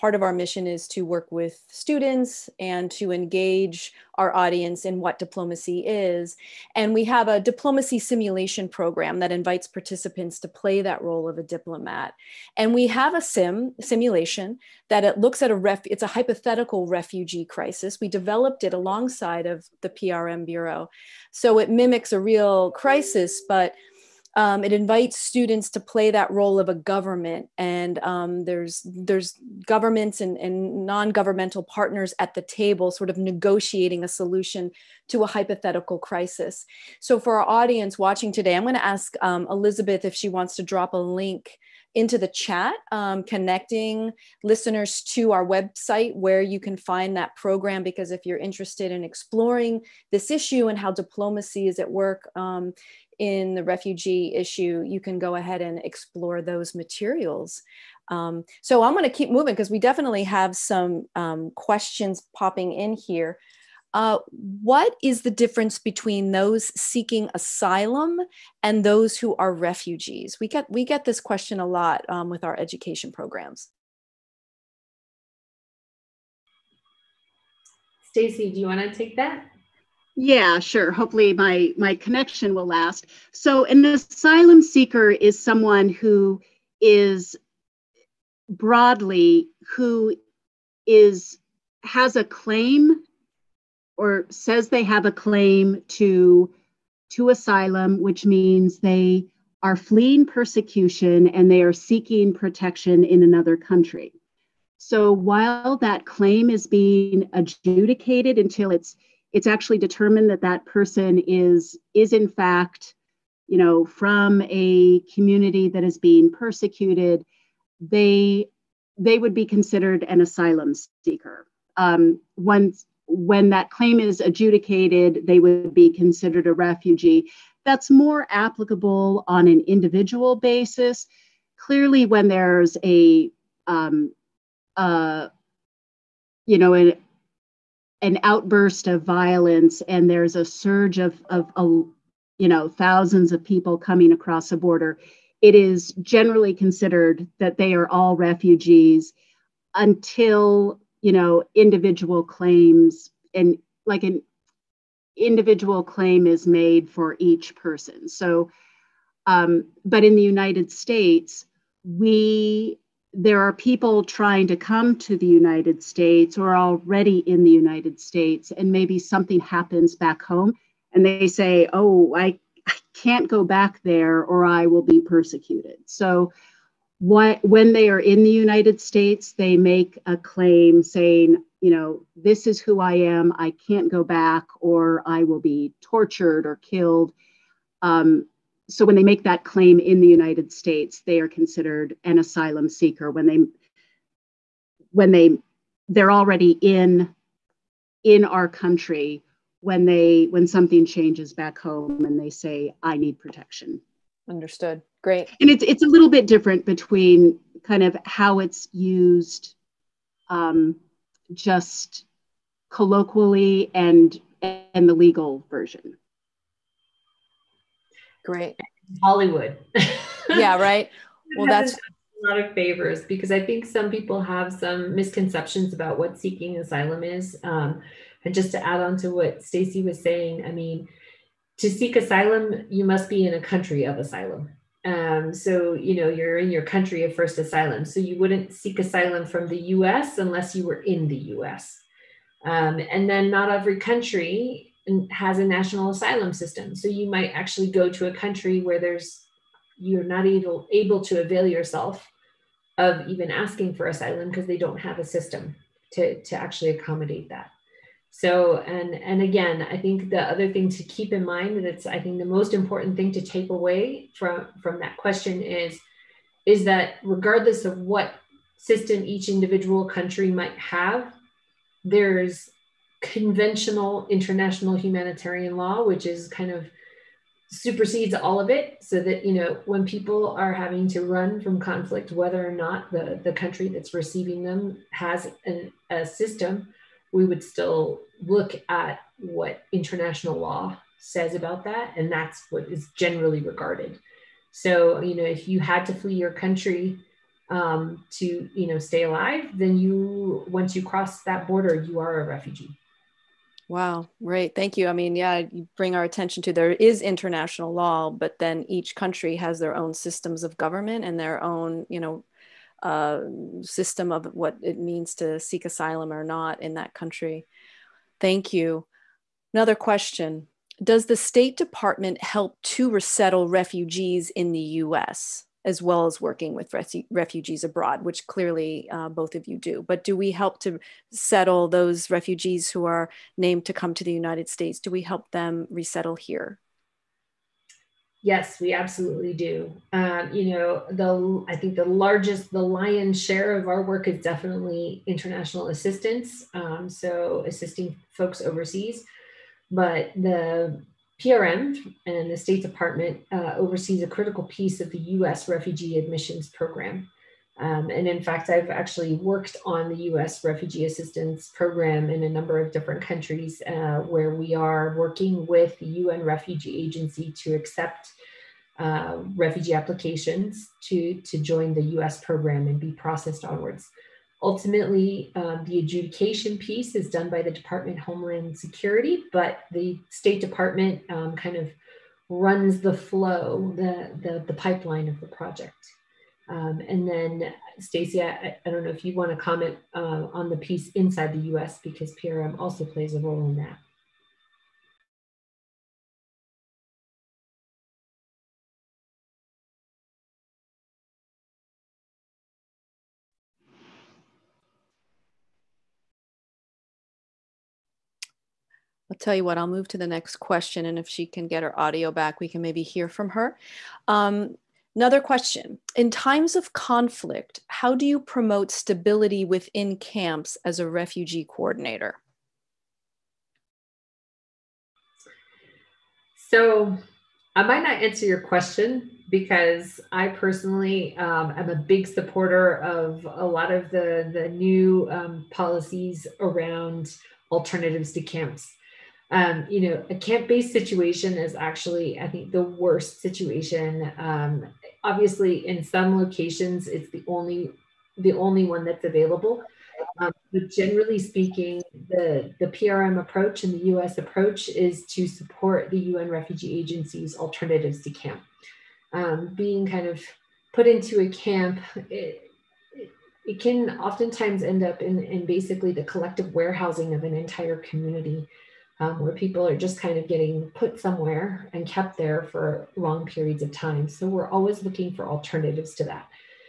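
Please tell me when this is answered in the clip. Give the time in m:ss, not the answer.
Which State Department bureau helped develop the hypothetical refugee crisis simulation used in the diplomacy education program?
0:19.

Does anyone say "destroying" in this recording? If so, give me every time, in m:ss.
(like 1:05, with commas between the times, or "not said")
not said.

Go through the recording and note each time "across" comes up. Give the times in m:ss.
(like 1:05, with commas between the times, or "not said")
2:24.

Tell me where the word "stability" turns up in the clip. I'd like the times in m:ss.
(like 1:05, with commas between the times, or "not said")
6:58.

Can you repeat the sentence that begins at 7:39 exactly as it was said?
Um, being kind of put into a camp.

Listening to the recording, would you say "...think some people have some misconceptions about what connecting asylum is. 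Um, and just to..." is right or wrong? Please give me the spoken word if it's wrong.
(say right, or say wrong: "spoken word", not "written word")
wrong: "seeking", not "connecting".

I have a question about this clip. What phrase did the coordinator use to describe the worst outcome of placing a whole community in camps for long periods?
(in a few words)
collective warehousing.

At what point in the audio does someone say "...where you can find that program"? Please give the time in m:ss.
0:46.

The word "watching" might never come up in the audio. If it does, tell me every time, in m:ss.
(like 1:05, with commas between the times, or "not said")
0:37.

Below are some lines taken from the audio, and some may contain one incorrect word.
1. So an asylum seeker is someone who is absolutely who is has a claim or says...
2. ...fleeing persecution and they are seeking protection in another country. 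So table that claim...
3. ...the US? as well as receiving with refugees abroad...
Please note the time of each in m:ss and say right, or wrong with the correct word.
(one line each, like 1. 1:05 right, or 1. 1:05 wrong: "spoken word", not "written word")
1. 1:23 wrong: "broadly", not "absolutely"
2. 1:39 wrong: "while", not "table"
3. 5:24 wrong: "working", not "receiving".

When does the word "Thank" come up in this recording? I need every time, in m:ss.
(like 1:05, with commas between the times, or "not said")
5:04, 5:18.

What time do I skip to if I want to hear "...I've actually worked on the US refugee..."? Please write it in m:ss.
5:58.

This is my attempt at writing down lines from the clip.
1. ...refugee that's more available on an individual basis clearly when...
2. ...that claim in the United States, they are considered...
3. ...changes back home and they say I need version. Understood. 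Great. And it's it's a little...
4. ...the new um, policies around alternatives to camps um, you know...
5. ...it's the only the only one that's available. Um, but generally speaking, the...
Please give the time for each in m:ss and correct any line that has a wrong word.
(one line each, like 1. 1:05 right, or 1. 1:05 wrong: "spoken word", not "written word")
1. 2:06 wrong: "applicable", not "available"
2. 3:09 right
3. 3:20 wrong: "protection", not "version"
4. 7:14 right
5. 7:26 right.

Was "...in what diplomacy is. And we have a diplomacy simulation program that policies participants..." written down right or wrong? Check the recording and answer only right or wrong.
wrong.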